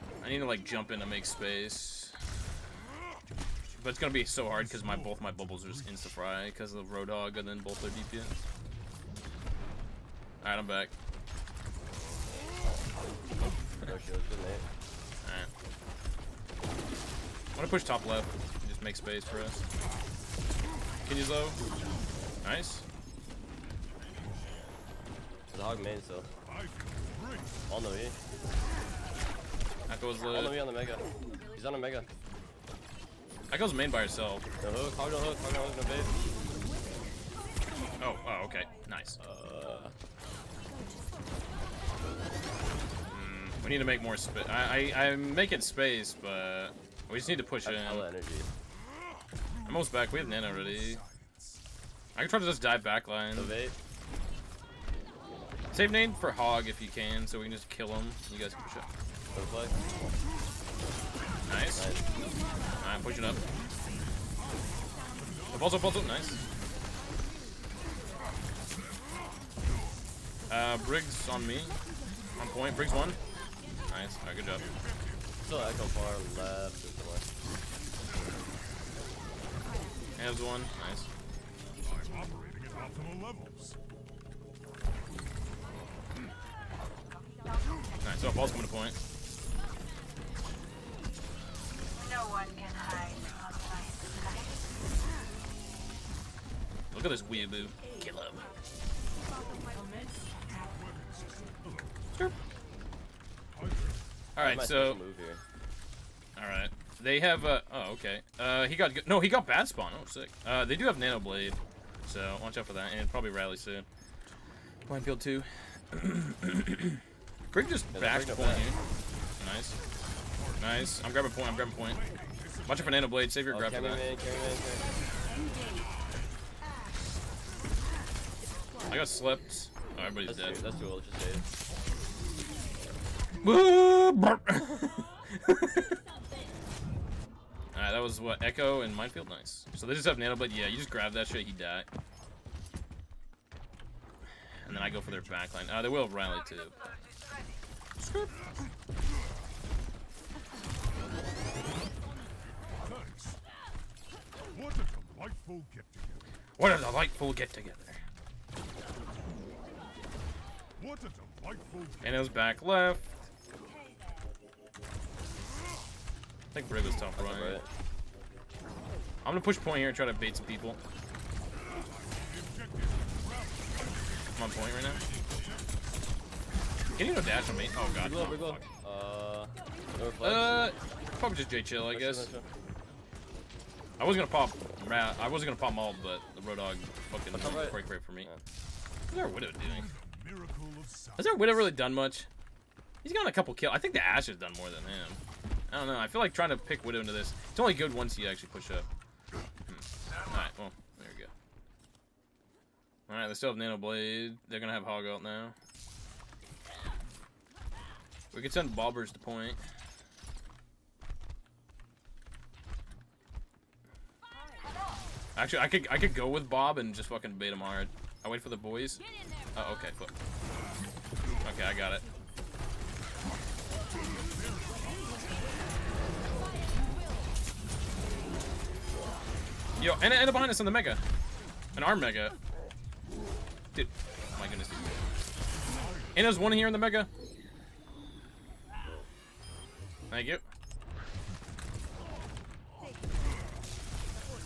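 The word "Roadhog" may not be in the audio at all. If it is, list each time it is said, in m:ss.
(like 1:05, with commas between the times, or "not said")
0:06, 3:06.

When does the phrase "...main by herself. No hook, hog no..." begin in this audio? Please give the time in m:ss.
0:33.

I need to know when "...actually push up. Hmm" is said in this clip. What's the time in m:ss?
3:18.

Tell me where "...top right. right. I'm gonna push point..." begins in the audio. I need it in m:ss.
2:46.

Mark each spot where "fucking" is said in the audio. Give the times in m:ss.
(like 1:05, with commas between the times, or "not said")
3:07, 3:37.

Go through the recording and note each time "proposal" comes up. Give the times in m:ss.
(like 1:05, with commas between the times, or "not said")
not said.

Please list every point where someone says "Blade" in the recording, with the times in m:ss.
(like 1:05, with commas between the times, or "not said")
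1:51, 2:03, 2:20, 3:23.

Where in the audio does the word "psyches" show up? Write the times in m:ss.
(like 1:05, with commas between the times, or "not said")
not said.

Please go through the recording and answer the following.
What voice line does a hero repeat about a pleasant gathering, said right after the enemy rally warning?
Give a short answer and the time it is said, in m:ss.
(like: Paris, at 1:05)
What a delightful get-together, at 2:36.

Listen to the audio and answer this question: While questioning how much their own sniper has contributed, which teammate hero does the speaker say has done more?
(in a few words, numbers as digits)
Ash.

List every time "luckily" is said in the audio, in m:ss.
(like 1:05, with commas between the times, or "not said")
not said.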